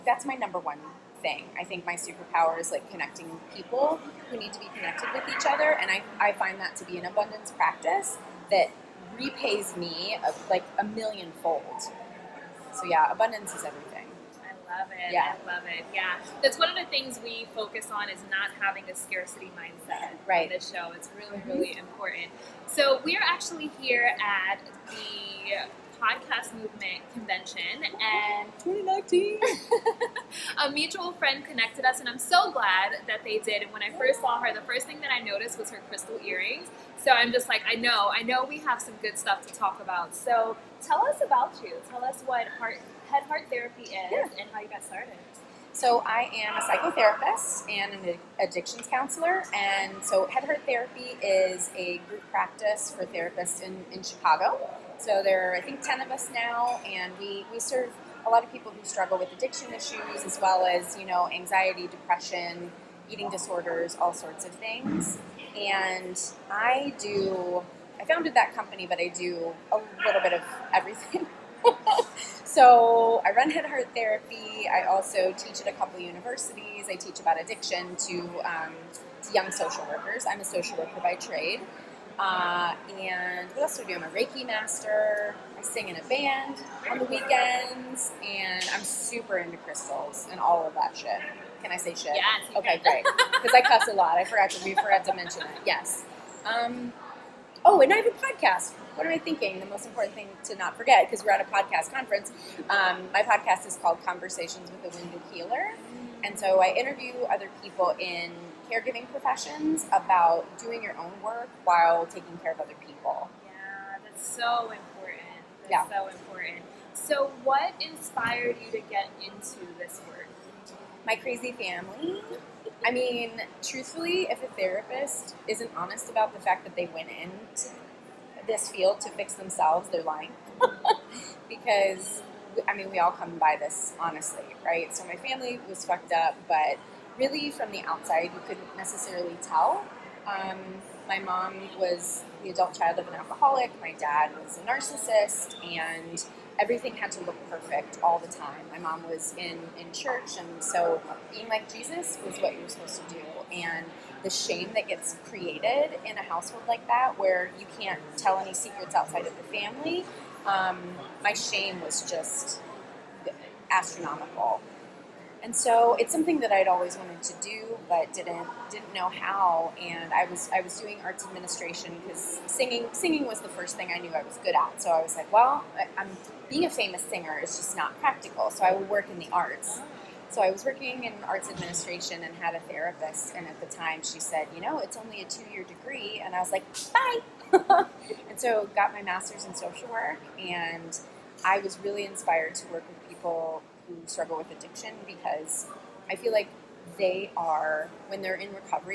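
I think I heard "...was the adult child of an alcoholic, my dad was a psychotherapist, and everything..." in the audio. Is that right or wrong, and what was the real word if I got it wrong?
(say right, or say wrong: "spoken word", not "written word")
wrong: "narcissist", not "psychotherapist".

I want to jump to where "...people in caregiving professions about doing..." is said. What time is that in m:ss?
1:47.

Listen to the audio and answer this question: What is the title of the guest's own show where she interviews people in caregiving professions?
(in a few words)
Conversations with a Wounded Healer.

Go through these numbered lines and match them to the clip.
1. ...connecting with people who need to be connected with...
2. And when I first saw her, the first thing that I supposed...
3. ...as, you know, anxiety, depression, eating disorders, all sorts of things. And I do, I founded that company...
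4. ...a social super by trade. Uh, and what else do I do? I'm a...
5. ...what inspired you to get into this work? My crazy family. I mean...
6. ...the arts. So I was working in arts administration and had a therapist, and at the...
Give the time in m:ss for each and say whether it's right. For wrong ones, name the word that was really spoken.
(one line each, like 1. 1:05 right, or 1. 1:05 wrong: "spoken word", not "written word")
1. 0:02 right
2. 0:33 wrong: "noticed", not "supposed"
3. 1:00 right
4. 1:20 wrong: "worker", not "super"
5. 1:57 right
6. 2:59 right.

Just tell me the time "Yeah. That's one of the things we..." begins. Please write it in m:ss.
0:15.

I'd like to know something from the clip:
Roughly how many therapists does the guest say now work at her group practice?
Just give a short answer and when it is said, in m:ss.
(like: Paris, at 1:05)
10, at 0:55.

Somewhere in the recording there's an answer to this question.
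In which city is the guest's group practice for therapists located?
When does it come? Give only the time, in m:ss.
0:54.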